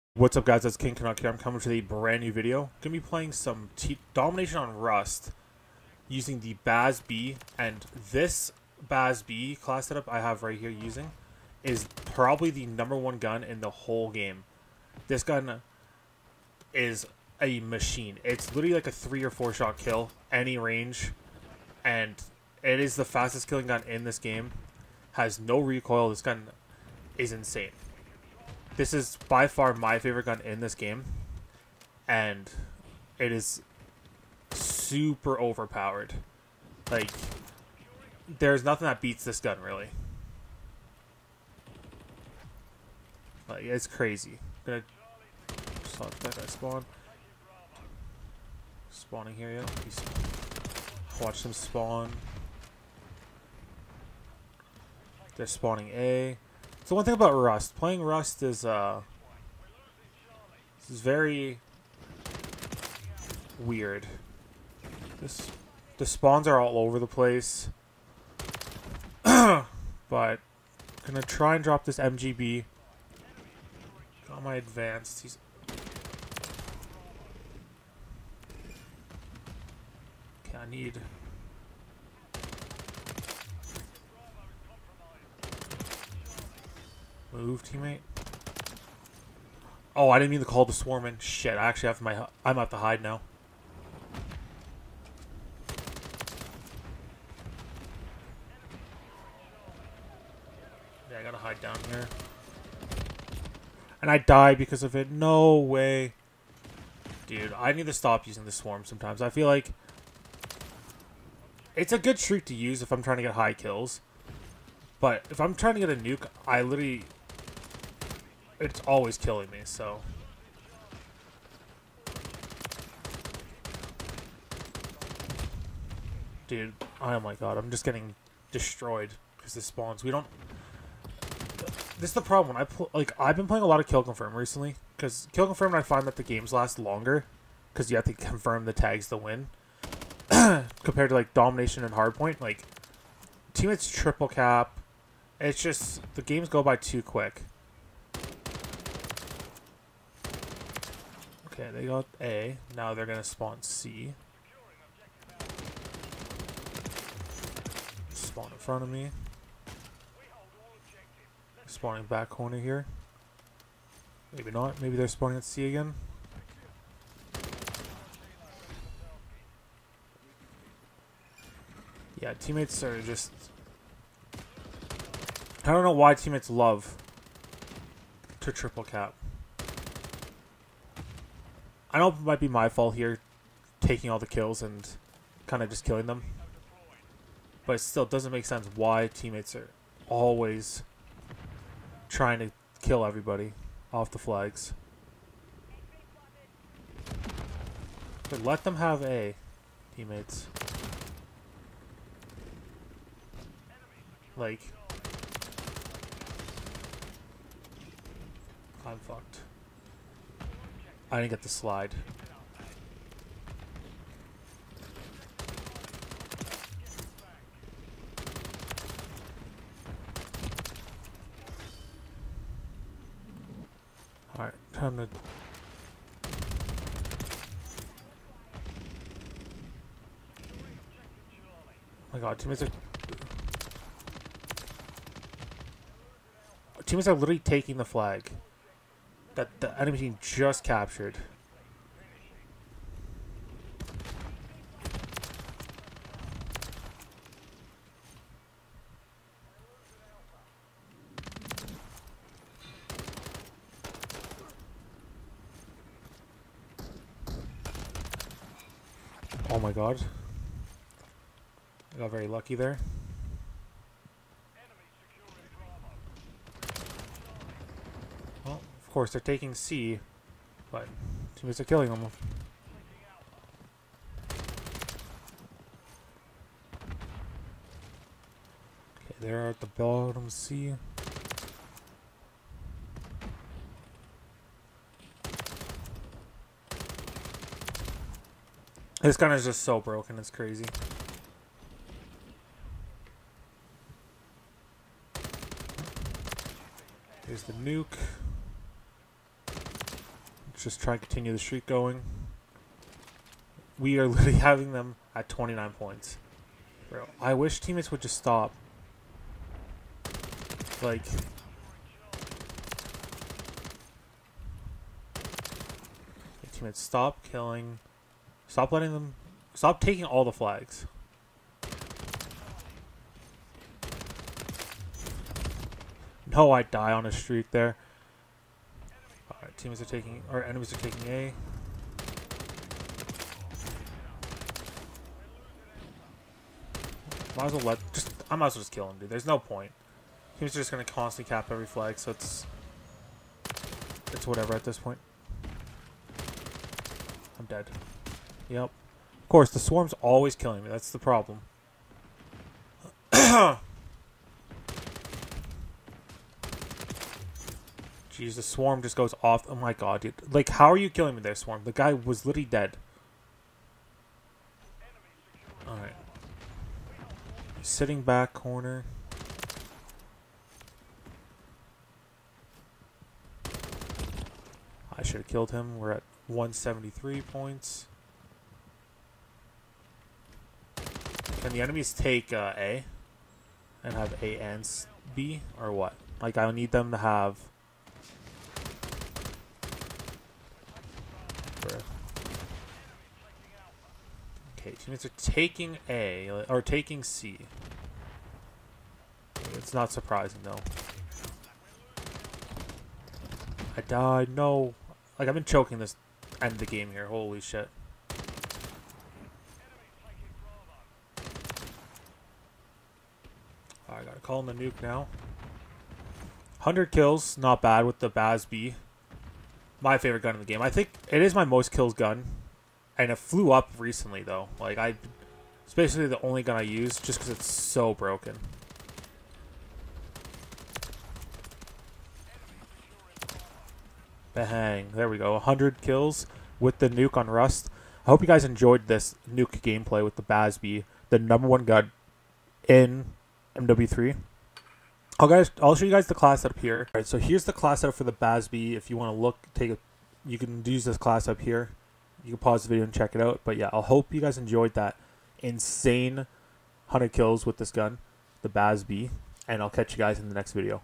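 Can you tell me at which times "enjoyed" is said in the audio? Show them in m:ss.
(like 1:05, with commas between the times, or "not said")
7:18, 7:34.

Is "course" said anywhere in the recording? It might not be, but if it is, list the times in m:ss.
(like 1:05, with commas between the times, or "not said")
4:28, 5:49.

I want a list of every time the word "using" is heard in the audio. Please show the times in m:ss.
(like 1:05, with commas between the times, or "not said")
0:06, 0:10, 1:48.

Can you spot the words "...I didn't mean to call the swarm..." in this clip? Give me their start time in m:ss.
1:30.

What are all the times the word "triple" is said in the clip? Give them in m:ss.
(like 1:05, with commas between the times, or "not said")
2:23, 2:58.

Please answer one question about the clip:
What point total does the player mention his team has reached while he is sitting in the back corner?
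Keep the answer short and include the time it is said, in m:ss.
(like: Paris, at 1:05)
173, at 6:16.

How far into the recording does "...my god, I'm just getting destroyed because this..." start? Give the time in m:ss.
2:07.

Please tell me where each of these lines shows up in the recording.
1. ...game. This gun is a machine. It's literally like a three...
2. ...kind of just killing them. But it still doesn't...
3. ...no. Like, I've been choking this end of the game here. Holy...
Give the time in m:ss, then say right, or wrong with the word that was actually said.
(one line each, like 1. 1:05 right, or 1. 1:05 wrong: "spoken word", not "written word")
1. 0:14 right
2. 3:05 right
3. 6:44 right.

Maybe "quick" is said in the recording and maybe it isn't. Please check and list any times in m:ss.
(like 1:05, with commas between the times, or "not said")
2:27.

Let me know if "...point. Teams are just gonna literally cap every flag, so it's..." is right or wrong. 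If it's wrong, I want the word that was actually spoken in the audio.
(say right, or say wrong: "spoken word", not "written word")
wrong: "constantly", not "literally".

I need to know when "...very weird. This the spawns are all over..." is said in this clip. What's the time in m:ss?
1:01.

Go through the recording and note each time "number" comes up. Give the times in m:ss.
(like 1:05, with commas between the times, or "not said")
0:12, 7:21.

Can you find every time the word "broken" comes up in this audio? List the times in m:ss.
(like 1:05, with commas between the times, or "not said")
4:49, 7:07.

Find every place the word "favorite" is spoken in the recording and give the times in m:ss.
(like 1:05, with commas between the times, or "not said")
0:29, 6:59.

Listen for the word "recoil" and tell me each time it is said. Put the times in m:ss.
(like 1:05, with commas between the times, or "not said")
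0:25.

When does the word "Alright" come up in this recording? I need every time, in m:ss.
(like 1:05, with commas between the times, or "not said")
3:44, 6:05.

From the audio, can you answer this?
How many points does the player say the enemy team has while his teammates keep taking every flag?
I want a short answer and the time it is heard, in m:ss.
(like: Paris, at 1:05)
29, at 5:05.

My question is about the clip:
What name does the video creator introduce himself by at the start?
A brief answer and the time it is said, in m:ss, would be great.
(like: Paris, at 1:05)
King Canuck, at 0:00.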